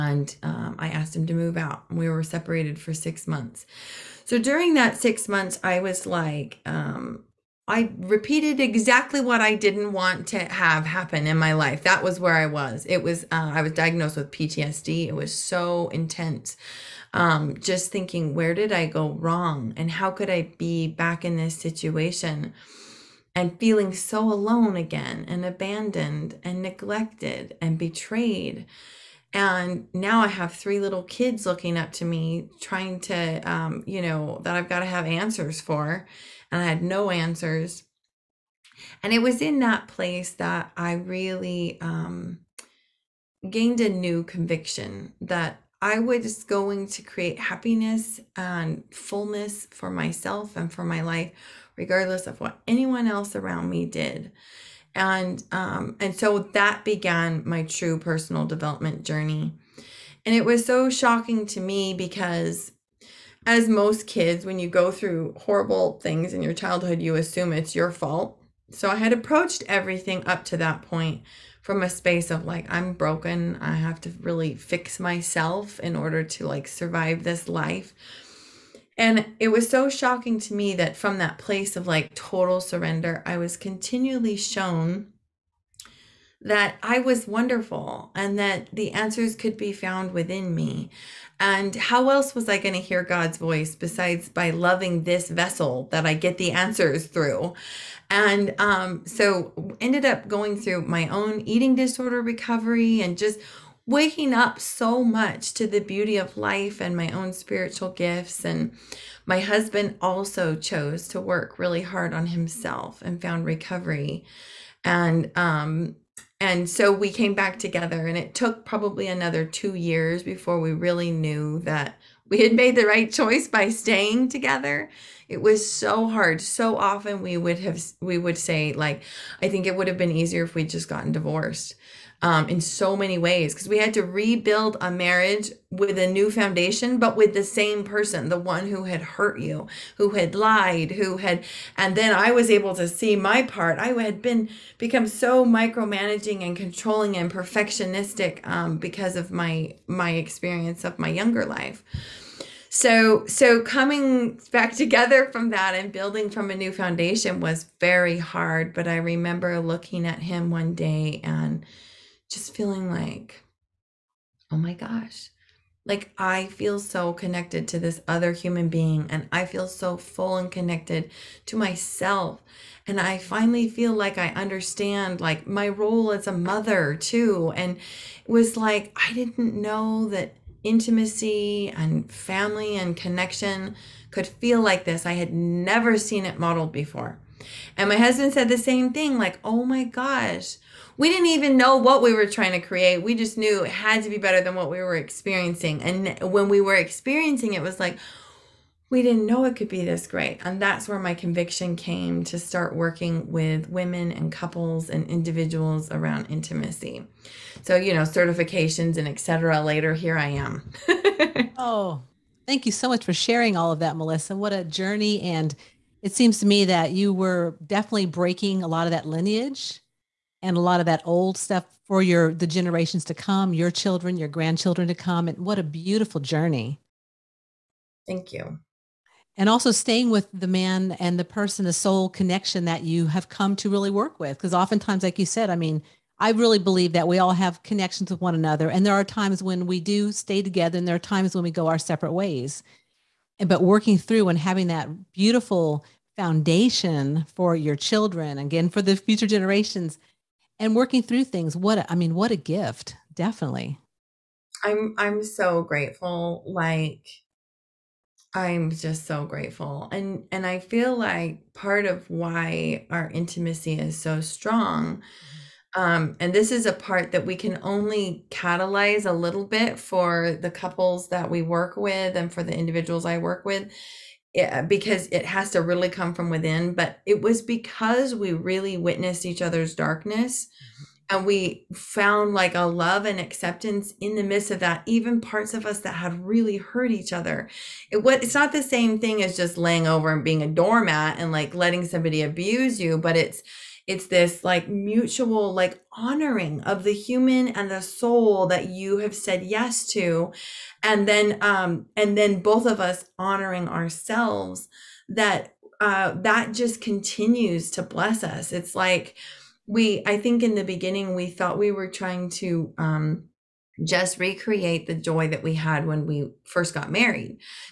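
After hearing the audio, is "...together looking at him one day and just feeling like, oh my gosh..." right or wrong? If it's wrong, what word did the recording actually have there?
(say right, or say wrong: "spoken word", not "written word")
wrong: "remember", not "together".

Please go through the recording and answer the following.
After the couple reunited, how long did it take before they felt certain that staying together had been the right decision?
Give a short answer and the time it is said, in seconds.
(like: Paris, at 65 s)
2 years, at 119 s.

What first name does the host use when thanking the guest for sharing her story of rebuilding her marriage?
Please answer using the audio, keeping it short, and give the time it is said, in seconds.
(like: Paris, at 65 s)
Melisa, at 213 s.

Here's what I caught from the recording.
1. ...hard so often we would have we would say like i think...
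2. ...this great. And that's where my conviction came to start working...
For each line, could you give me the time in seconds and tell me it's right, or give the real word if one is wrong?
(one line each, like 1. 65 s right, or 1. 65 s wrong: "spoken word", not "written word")
1. 126 s right
2. 199 s right.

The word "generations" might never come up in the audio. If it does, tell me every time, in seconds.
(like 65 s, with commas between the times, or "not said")
222 s, 249 s.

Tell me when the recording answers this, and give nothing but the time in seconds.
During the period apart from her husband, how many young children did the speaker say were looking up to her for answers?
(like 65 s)
30 s.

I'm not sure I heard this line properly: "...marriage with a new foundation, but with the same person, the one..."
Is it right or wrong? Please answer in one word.
right.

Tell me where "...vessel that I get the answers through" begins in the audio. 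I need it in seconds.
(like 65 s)
95 s.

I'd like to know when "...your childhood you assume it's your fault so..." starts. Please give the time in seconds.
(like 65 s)
66 s.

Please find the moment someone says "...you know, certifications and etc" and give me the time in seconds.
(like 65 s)
207 s.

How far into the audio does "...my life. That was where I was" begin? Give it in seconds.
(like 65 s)
11 s.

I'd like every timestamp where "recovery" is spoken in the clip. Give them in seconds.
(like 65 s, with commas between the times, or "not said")
102 s, 113 s.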